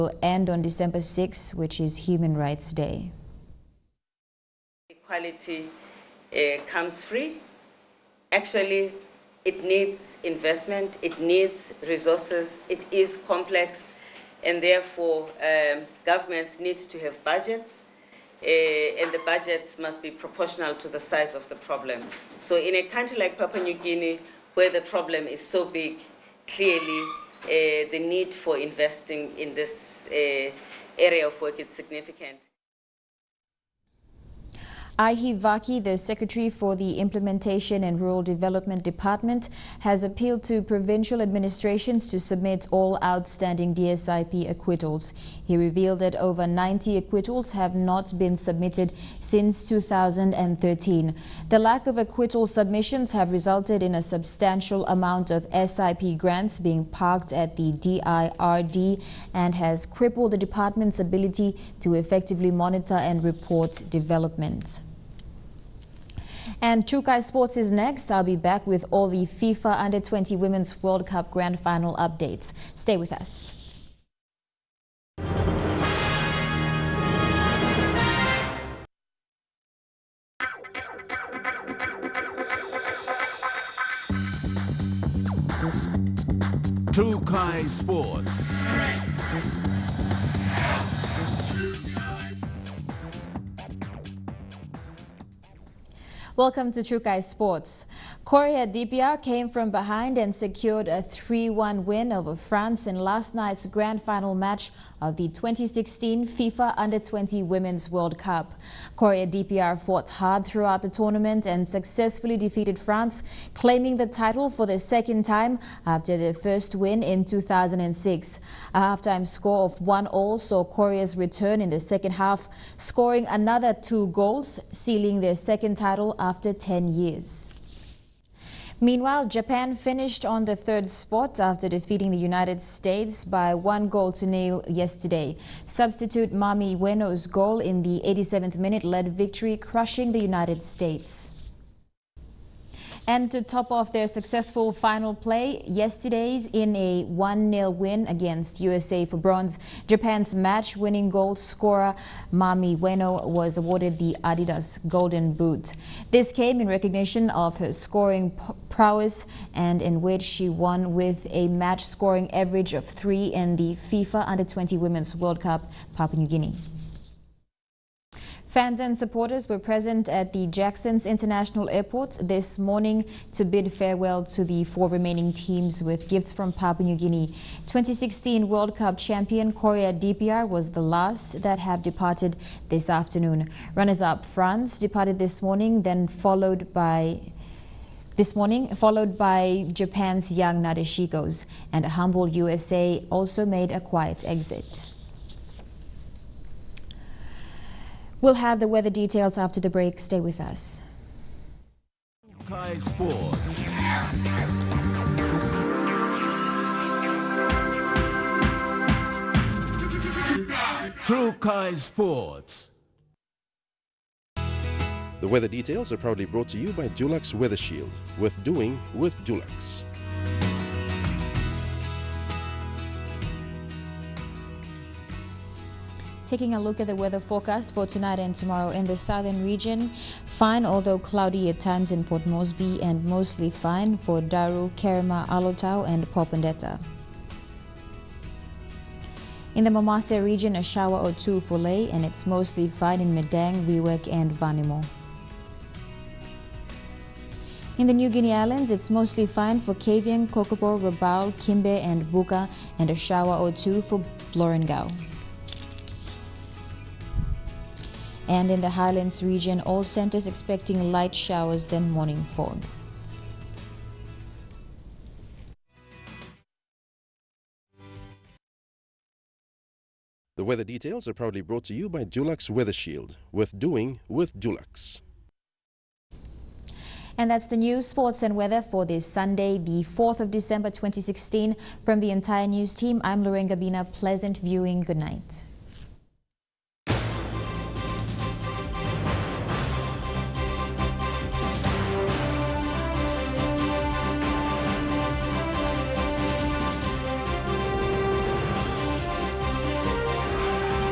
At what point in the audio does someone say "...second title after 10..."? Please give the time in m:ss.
2:05.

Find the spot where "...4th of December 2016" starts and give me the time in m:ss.
4:39.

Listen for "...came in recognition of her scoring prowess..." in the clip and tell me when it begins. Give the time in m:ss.
2:36.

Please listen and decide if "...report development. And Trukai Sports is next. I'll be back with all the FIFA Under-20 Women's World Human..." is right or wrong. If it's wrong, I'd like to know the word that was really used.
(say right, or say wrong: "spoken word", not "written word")
wrong: "Cup", not "Human".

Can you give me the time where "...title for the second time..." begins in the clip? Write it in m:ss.
1:54.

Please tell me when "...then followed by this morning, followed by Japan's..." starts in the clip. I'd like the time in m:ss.
3:05.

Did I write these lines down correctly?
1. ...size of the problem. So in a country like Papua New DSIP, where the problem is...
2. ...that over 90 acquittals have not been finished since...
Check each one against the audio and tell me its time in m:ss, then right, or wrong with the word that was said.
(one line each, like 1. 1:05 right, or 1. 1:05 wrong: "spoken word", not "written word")
1. 0:20 wrong: "Guinea", not "DSIP"
2. 0:45 wrong: "submitted", not "finished".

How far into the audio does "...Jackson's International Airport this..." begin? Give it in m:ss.
2:50.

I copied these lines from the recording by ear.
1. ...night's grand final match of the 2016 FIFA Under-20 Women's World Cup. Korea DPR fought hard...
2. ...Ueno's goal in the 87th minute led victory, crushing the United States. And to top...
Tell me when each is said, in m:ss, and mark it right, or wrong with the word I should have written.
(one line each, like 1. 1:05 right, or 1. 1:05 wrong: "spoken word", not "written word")
1. 1:43 right
2. 2:16 right.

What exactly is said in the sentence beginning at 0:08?
Actually, it needs investment, it needs resources, it is complex, and therefore um, governments need to have budgets.